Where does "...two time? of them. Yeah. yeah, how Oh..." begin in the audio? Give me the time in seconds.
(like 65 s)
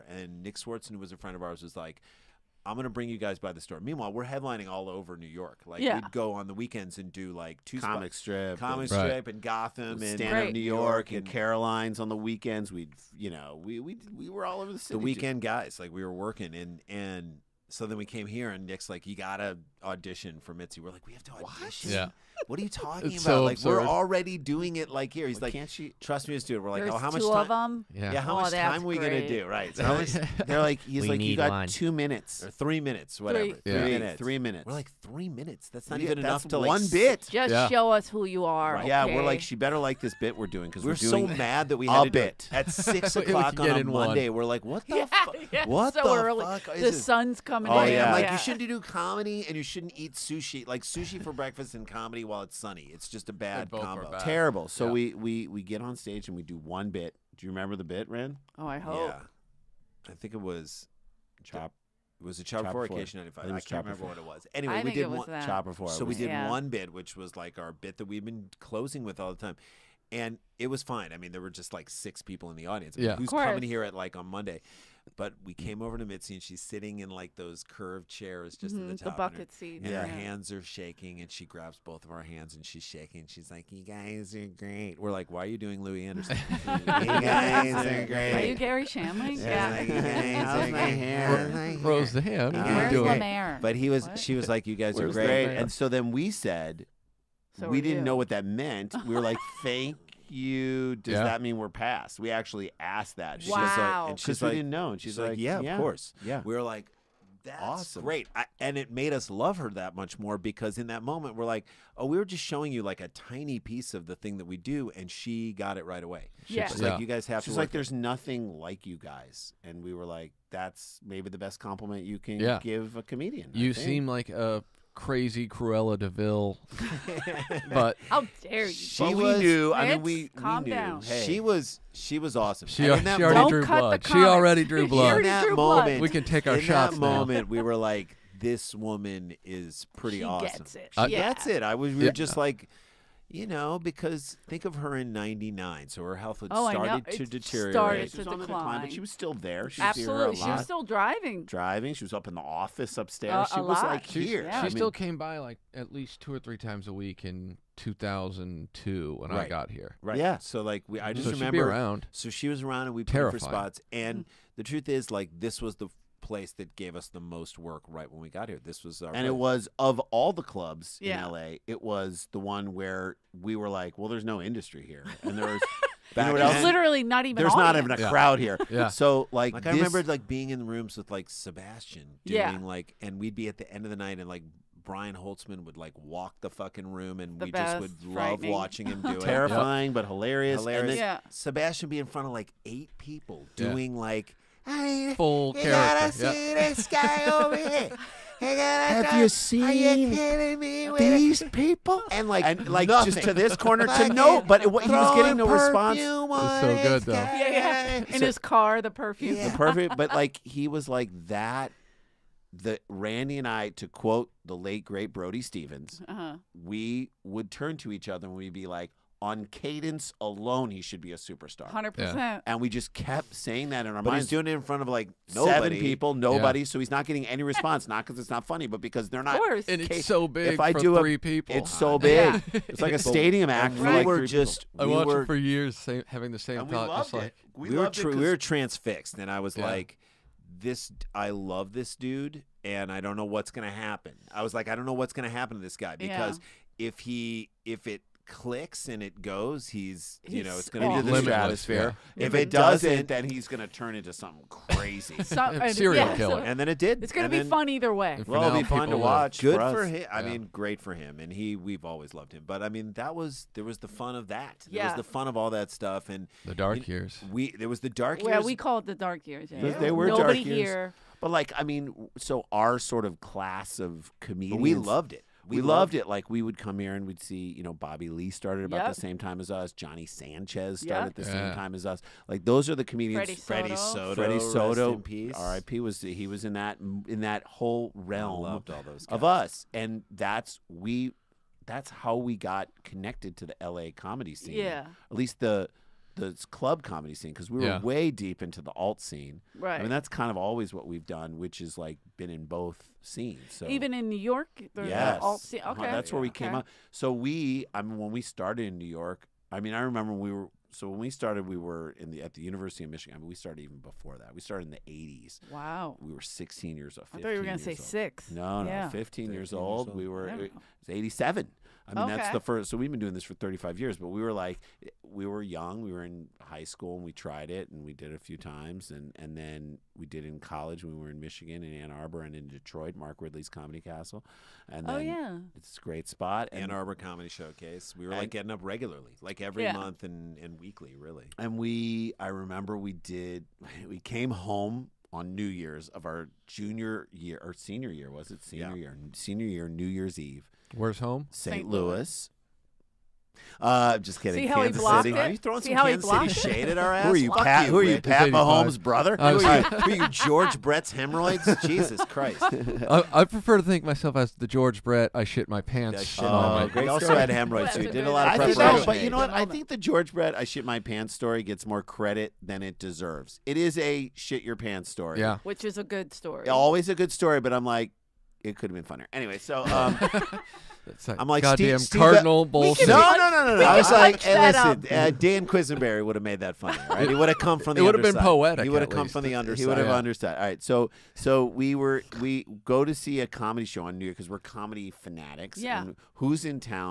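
27 s.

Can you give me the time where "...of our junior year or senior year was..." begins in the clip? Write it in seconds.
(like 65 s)
345 s.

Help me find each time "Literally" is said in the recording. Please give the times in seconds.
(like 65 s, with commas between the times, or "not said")
176 s.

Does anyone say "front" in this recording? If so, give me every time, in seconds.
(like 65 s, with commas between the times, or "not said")
192 s, 224 s.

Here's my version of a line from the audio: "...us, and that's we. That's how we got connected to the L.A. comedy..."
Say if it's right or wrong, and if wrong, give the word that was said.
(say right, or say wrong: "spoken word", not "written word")
right.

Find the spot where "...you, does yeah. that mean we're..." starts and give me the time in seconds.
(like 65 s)
100 s.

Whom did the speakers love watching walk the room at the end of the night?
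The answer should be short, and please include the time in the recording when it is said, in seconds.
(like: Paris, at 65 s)
Brian Holtzman, at 184 s.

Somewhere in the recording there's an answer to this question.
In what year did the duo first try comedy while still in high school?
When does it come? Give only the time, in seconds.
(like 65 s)
320 s.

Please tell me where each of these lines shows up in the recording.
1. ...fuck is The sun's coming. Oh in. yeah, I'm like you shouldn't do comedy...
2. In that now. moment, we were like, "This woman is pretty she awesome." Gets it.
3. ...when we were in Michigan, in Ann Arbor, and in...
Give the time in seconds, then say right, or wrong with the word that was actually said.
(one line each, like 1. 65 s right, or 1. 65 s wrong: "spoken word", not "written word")
1. 46 s right
2. 136 s right
3. 330 s right.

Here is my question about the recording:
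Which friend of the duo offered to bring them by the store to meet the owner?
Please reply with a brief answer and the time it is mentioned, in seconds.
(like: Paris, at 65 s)
Nick Swardson, at 0 s.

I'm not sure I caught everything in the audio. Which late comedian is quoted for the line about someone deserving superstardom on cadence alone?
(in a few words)
Brody Stevens.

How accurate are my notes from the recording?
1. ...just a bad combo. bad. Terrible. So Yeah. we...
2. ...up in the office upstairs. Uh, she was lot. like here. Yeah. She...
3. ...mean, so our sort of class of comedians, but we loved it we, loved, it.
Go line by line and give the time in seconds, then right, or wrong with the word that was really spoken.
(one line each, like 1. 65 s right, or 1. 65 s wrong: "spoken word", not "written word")
1. 53 s right
2. 152 s right
3. 271 s right.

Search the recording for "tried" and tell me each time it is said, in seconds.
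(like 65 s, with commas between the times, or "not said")
327 s.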